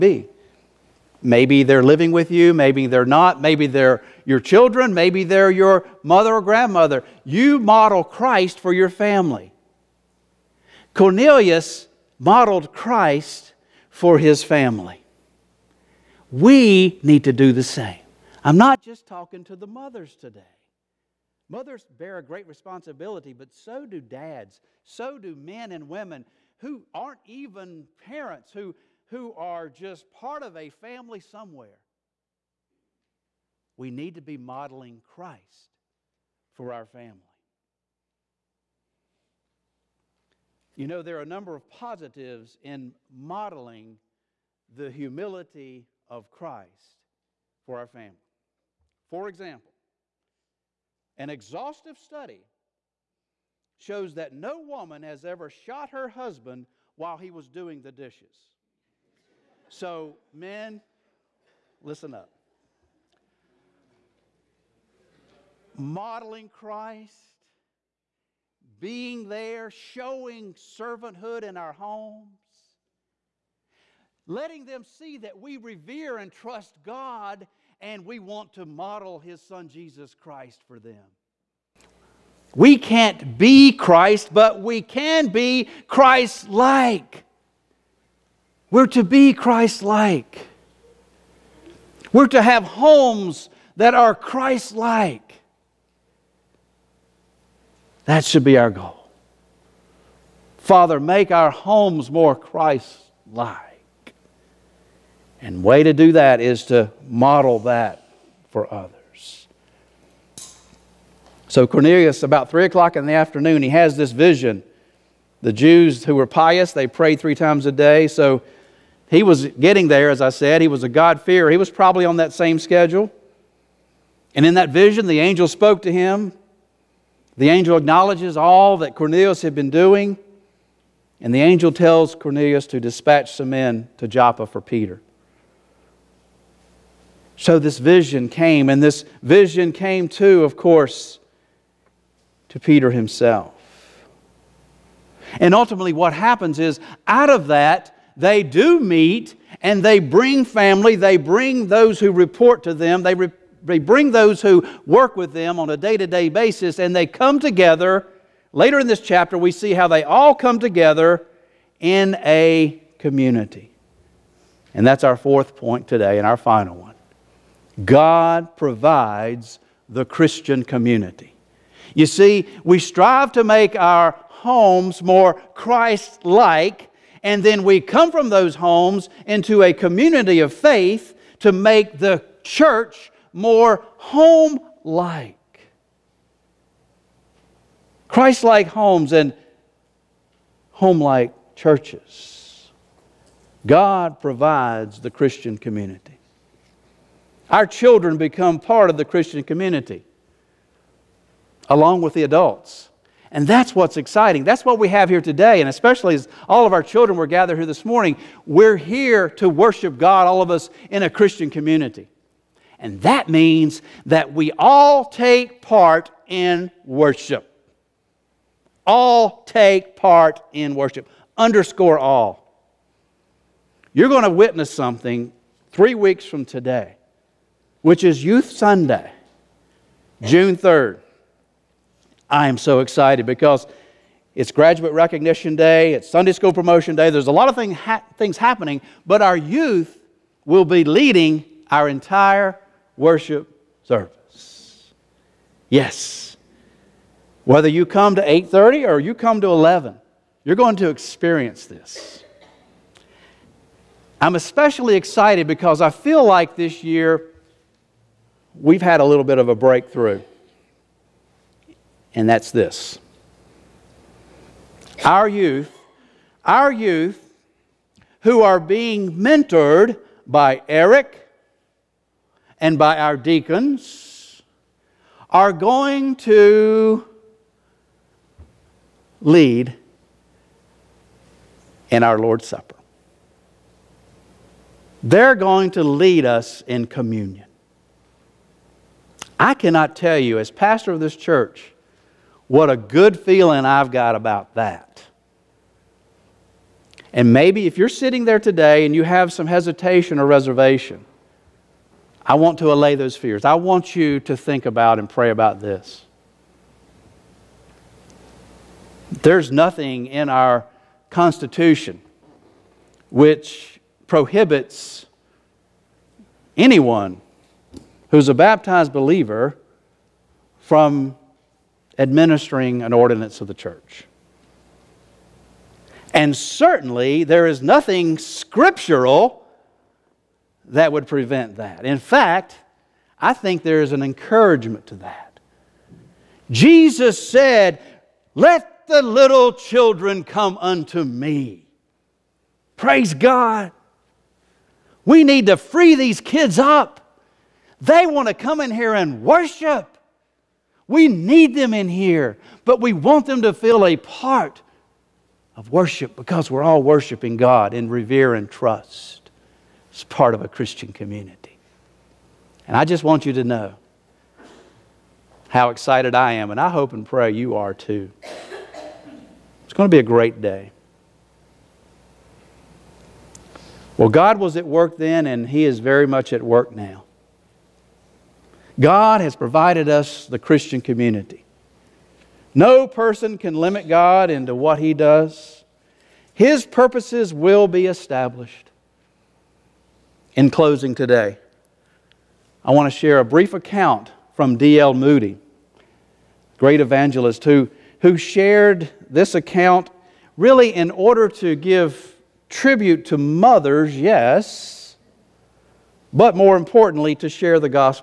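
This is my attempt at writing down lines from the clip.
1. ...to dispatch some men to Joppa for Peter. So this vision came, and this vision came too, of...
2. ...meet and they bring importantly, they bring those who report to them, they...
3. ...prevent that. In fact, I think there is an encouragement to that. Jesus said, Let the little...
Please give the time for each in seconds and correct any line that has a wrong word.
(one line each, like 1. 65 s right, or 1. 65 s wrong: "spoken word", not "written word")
1. 132 s right
2. 148 s wrong: "family", not "importantly"
3. 331 s right.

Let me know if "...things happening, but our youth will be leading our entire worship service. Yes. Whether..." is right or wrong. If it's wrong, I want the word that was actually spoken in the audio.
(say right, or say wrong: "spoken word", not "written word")
right.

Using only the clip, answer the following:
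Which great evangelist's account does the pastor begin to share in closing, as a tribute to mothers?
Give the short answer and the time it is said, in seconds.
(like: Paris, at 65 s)
D.L. Moody, at 394 s.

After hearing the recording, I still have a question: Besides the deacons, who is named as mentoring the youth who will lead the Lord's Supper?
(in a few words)
Eric.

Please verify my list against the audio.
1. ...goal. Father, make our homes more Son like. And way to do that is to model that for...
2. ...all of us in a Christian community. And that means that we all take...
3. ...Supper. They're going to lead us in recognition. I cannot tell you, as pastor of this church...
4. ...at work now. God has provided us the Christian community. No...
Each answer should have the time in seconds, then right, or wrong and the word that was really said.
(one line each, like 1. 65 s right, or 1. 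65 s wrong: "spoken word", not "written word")
1. 98 s wrong: "Christ", not "Son"
2. 210 s right
3. 282 s wrong: "communion", not "recognition"
4. 376 s right.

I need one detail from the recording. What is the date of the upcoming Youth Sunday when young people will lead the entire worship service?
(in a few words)
June 3rd.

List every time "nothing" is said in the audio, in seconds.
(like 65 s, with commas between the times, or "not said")
309 s, 327 s.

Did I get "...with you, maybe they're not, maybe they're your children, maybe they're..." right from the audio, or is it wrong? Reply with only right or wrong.
right.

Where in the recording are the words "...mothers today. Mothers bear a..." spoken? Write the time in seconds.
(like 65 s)
19 s.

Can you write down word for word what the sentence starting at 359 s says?
It's part of a Christian community.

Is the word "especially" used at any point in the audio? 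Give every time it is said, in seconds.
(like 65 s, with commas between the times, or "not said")
205 s, 254 s.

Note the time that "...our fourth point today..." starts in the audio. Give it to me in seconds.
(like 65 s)
165 s.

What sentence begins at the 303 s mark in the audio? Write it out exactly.
I want you to think about and pray about this.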